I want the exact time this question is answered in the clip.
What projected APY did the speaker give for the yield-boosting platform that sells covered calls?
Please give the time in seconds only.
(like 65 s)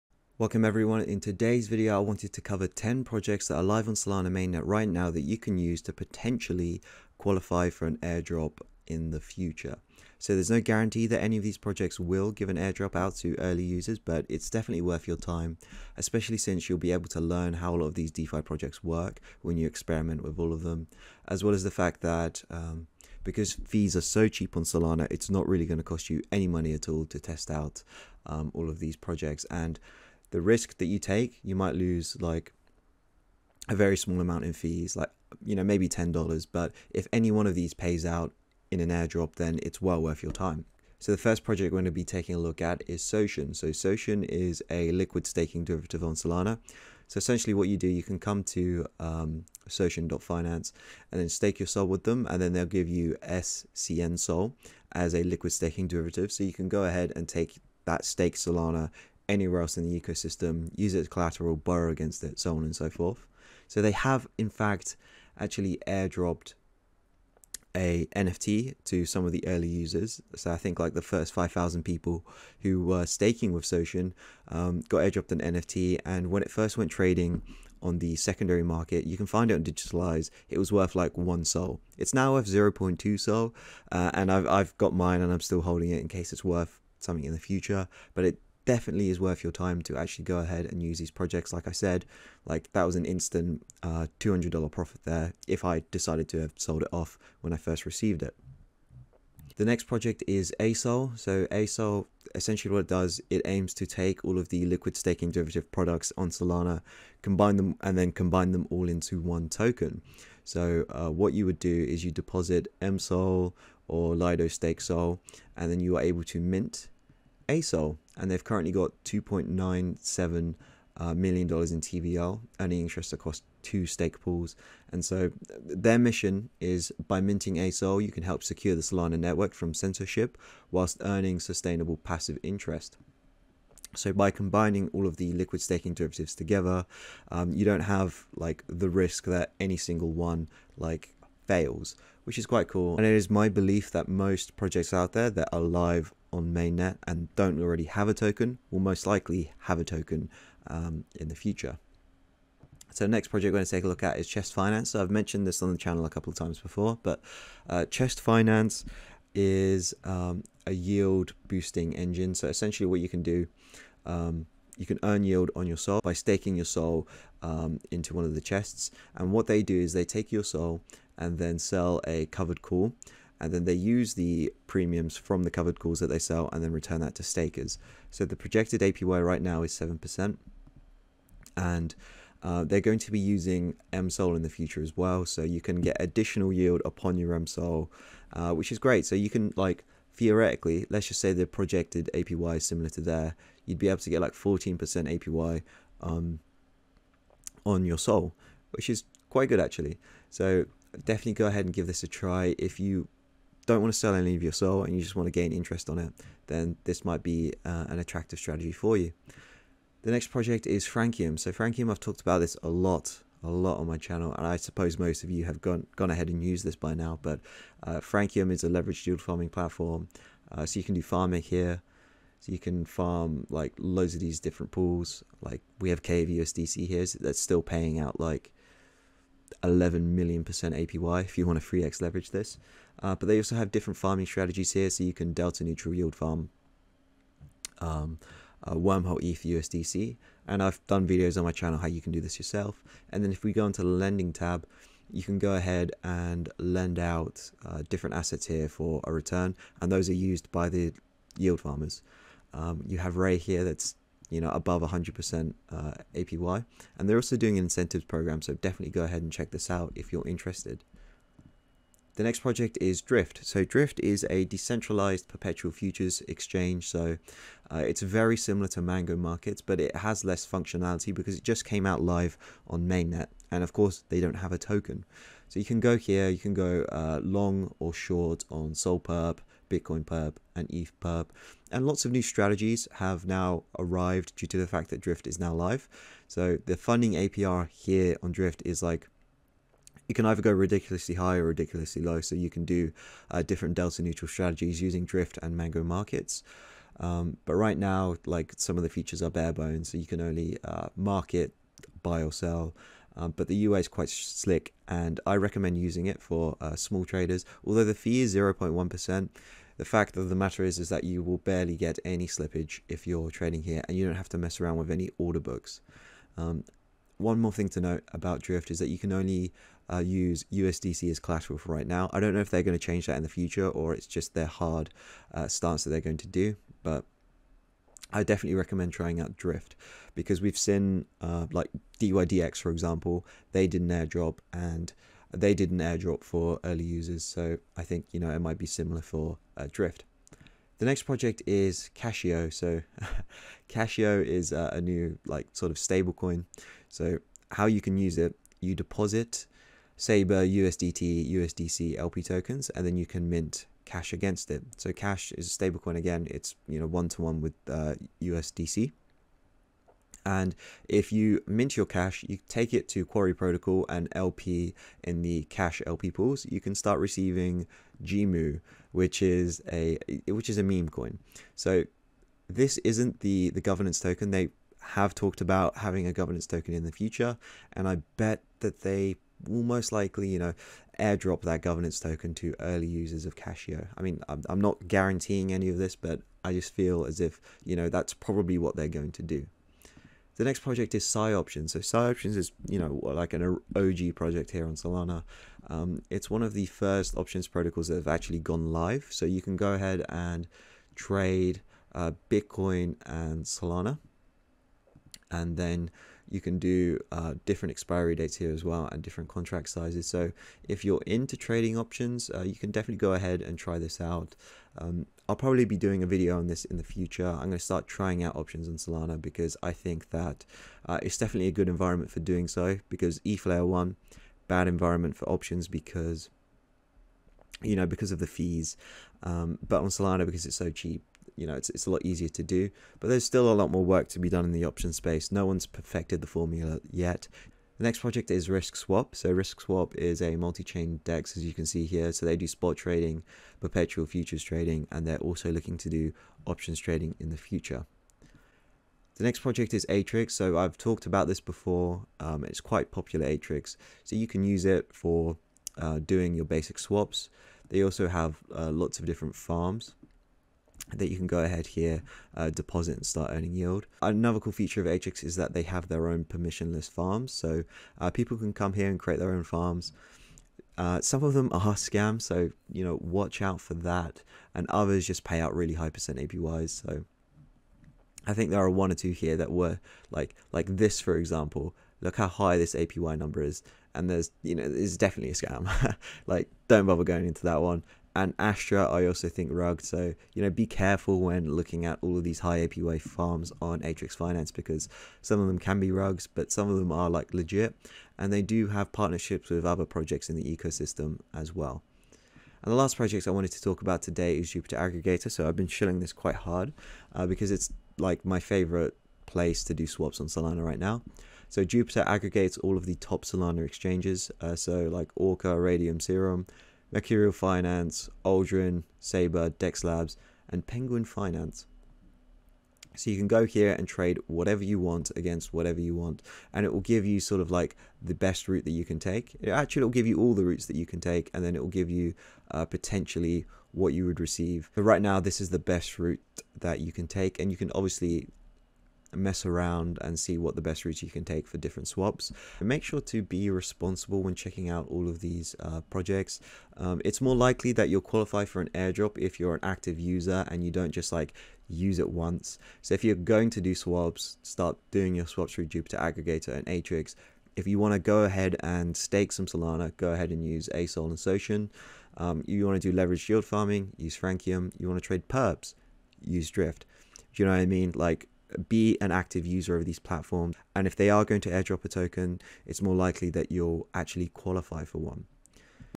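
179 s.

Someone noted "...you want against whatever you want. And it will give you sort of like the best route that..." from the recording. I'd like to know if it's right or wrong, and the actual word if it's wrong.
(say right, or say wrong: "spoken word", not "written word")
right.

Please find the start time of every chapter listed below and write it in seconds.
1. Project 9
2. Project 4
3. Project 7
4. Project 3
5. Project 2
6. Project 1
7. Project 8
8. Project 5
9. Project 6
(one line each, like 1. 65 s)
1. 450 s
2. 207 s
3. 390 s
4. 153 s
5. 98 s
6. 40 s
7. 437 s
8. 262 s
9. 341 s.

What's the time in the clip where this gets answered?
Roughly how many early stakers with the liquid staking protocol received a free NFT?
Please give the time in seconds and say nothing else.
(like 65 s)
71 s.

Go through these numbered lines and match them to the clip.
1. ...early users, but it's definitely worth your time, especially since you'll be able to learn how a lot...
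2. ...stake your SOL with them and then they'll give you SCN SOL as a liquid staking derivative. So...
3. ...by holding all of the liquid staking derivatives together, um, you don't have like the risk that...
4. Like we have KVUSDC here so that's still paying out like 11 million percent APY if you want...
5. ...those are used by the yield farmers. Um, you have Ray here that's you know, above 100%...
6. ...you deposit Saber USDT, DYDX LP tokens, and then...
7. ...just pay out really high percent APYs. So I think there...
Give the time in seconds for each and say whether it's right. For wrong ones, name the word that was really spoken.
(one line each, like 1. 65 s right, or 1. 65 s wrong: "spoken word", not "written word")
1. 13 s right
2. 51 s right
3. 134 s wrong: "combining", not "holding"
4. 225 s right
5. 249 s right
6. 348 s wrong: "USDC", not "DYDX"
7. 475 s right.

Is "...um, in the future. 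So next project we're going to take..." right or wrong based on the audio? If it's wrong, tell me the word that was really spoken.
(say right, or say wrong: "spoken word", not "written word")
right.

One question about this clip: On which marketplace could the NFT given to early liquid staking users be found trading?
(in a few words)
DigitalEyes.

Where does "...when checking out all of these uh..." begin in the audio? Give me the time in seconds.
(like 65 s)
544 s.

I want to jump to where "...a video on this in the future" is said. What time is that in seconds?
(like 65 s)
416 s.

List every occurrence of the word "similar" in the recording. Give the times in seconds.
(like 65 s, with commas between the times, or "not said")
192 s, 268 s, 338 s.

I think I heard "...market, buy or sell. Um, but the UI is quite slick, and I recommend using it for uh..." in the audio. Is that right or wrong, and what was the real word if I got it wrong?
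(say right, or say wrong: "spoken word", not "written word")
right.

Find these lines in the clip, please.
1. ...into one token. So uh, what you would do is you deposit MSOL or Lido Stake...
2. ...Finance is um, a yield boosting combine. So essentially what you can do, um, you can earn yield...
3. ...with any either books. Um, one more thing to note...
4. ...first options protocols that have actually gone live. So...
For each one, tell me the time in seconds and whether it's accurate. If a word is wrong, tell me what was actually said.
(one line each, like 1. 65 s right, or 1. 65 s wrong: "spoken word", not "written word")
1. 108 s right
2. 158 s wrong: "engine", not "combine"
3. 314 s wrong: "order", not "either"
4. 396 s right.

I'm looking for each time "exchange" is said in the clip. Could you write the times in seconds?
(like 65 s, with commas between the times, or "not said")
266 s, 513 s.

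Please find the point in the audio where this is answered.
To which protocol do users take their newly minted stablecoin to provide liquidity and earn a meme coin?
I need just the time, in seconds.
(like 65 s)
363 s.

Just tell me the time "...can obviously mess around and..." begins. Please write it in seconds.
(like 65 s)
537 s.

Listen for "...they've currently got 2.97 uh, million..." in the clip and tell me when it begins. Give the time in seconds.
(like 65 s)
118 s.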